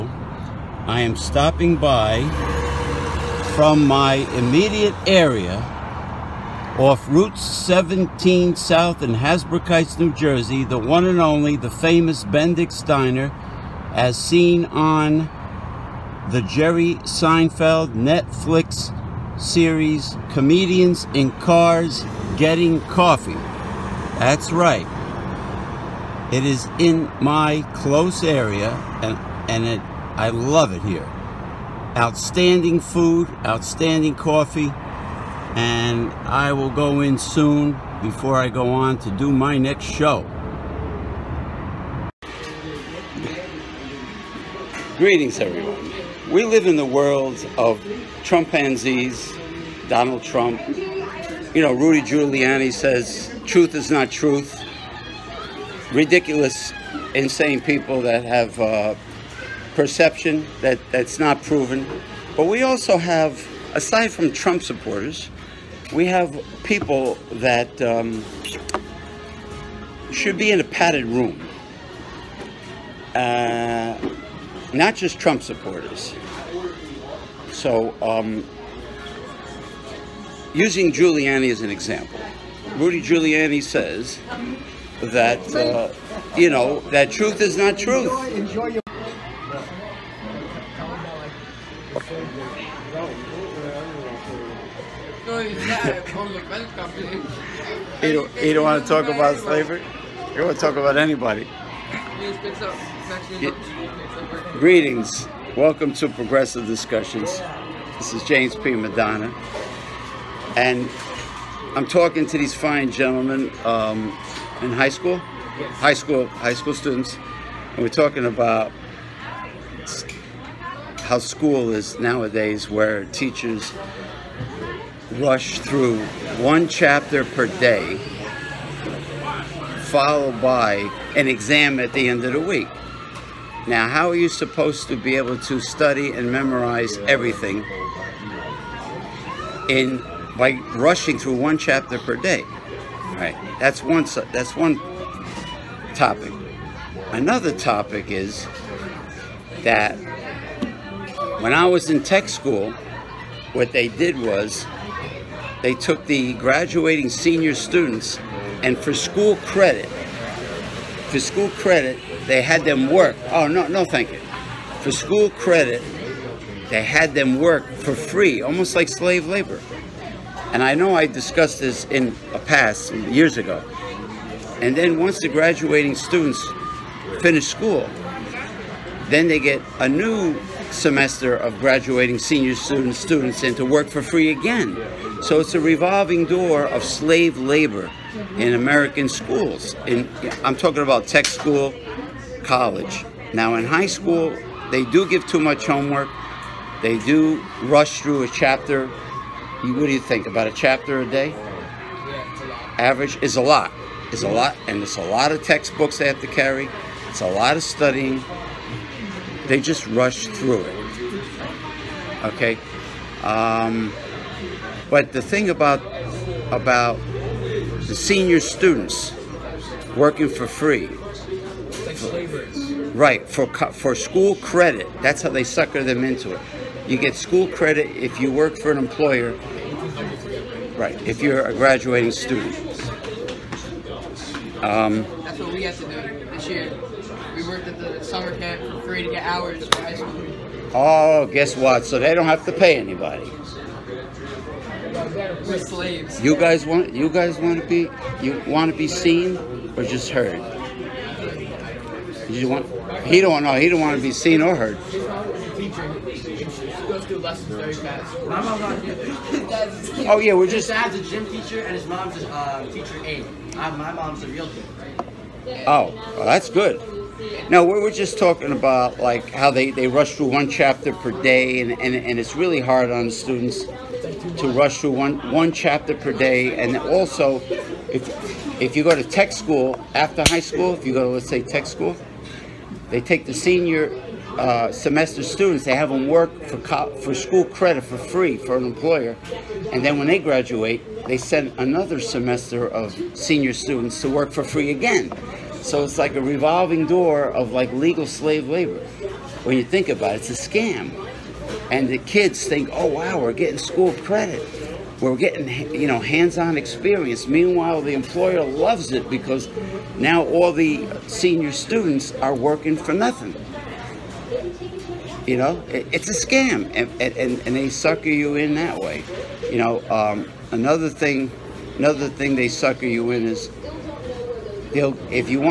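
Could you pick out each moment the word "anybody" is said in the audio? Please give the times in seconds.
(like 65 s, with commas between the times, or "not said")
100 s, 242 s.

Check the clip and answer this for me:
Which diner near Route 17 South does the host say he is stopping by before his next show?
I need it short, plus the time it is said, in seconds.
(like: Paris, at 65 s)
Bendix Diner, at 12 s.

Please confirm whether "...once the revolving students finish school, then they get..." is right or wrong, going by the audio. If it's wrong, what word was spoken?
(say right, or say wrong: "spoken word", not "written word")
wrong: "graduating", not "revolving".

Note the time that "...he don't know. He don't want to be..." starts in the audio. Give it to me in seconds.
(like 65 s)
253 s.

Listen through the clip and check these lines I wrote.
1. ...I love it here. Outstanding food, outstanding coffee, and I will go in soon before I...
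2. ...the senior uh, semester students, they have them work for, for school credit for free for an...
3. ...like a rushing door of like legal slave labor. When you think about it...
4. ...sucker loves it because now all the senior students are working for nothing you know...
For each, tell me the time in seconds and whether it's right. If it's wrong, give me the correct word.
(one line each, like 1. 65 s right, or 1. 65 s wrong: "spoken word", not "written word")
1. 30 s right
2. 283 s right
3. 295 s wrong: "revolving", not "rushing"
4. 307 s wrong: "employer", not "sucker".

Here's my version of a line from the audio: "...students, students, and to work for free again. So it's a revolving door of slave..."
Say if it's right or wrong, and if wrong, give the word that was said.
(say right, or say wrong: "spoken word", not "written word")
right.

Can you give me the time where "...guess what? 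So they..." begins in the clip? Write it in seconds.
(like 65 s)
241 s.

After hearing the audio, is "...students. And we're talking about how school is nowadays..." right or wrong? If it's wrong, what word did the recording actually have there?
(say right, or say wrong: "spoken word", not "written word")
right.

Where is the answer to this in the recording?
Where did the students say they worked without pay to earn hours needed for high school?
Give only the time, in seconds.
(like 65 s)
238 s.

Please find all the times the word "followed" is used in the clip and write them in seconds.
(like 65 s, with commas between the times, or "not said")
129 s.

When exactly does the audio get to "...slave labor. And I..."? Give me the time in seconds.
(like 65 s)
168 s.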